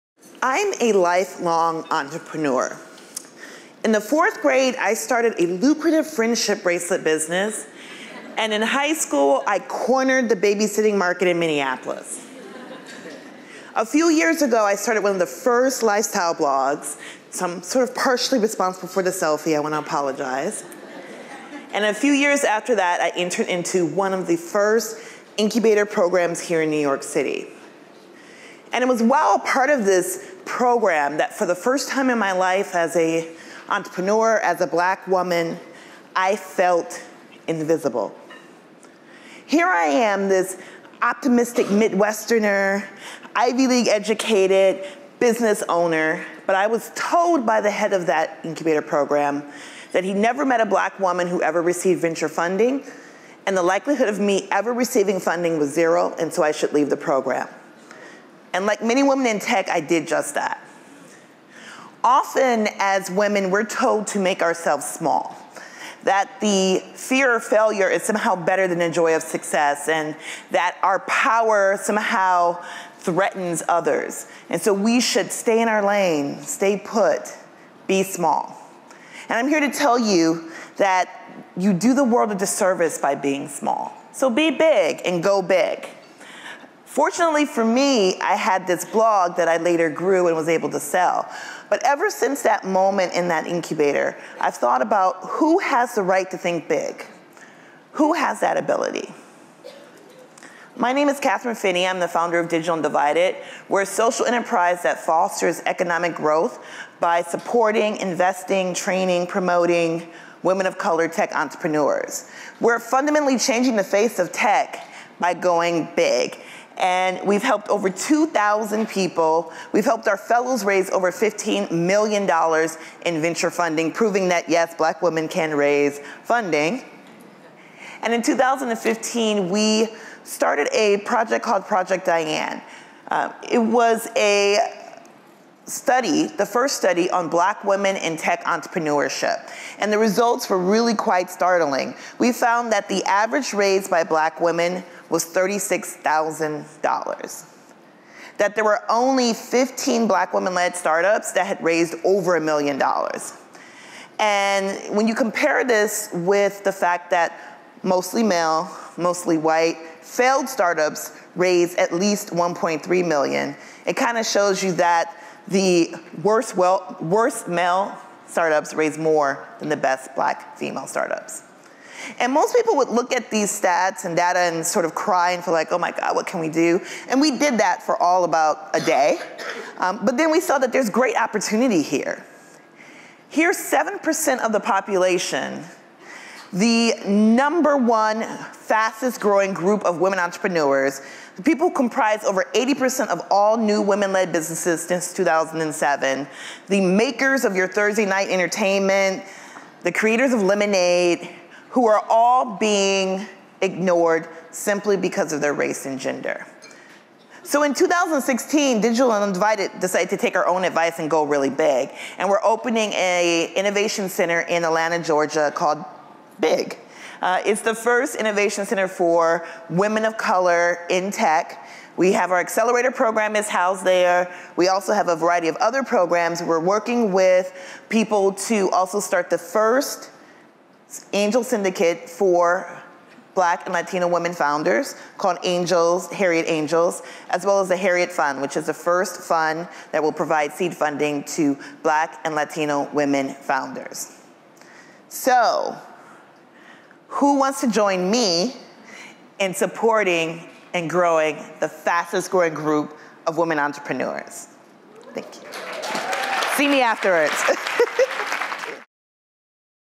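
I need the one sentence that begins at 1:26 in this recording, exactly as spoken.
Fortunately for me, I had this blog that I later grew and was able to sell.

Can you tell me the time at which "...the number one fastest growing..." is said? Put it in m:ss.
3:06.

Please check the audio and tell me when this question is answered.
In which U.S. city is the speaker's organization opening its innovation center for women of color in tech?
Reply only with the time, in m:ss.
3:34.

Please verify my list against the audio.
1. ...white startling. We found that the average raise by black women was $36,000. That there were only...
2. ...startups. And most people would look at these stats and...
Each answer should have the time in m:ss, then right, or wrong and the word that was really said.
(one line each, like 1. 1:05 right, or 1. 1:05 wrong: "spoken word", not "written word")
1. 2:20 wrong: "quite", not "white"
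2. 2:50 right.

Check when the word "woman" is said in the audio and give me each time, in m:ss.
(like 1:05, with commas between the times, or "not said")
0:35, 0:50.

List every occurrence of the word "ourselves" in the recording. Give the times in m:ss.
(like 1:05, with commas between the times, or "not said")
1:04.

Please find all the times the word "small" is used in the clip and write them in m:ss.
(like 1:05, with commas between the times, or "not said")
1:04, 1:18, 1:23.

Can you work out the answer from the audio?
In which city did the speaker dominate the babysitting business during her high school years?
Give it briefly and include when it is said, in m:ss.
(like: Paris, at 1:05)
Minneapolis, at 0:11.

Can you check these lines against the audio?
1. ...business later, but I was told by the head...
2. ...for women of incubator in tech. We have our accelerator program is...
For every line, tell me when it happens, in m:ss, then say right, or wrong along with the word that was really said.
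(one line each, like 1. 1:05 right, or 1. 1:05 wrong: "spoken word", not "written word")
1. 0:45 wrong: "owner", not "later"
2. 3:38 wrong: "color", not "incubator".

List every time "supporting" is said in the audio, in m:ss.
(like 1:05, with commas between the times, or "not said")
1:47, 4:09.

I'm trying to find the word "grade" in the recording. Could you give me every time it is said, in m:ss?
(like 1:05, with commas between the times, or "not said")
0:04.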